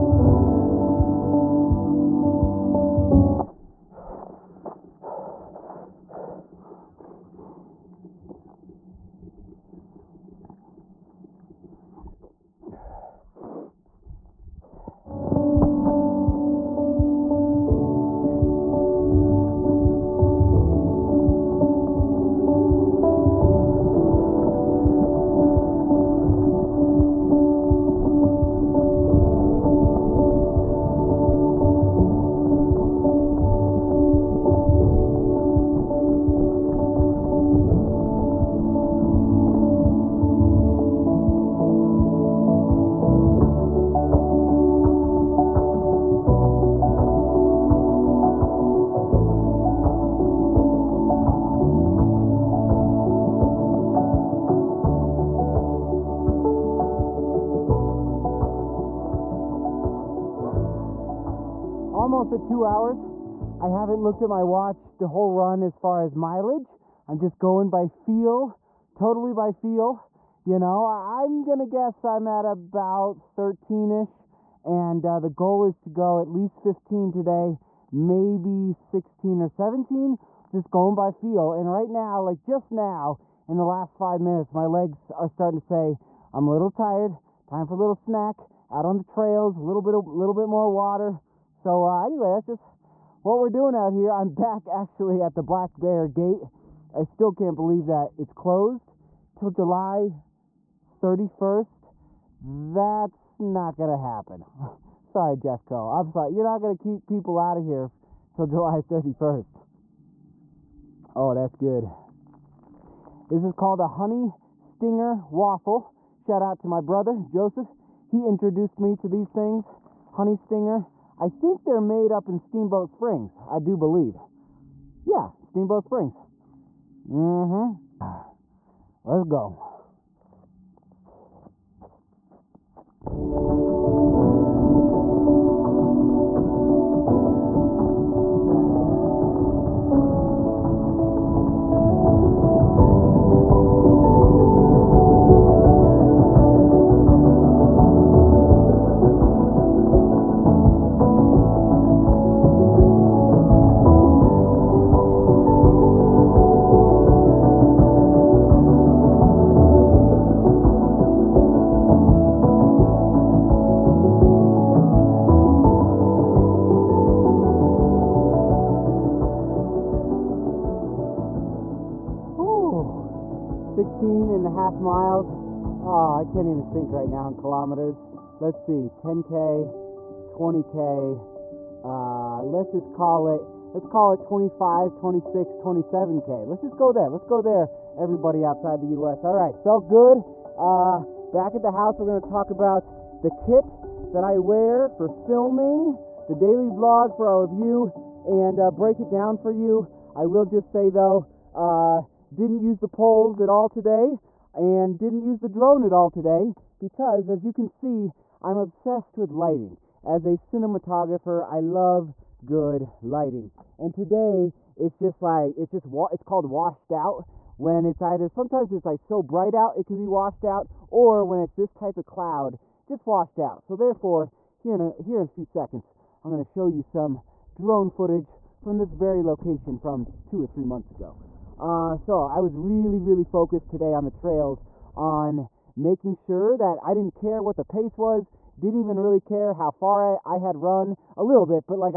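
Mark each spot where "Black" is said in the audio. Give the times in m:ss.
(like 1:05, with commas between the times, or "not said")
1:35.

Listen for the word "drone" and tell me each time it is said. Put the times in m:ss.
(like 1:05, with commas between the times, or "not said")
3:25, 3:47.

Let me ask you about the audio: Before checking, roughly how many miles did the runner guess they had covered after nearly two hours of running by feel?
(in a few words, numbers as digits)
13.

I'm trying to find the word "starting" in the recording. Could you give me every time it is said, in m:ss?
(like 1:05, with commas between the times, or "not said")
1:25.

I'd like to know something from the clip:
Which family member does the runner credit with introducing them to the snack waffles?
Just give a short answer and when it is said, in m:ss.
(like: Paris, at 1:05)
Joseph, at 1:57.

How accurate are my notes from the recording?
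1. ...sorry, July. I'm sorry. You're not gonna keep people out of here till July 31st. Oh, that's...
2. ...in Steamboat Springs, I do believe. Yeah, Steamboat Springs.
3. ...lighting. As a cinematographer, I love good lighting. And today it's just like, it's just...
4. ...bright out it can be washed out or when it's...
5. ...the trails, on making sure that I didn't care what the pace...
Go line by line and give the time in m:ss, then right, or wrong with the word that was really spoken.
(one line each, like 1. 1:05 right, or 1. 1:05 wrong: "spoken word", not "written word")
1. 1:45 wrong: "Jeffco", not "July"
2. 2:02 right
3. 3:29 right
4. 3:39 right
5. 3:54 right.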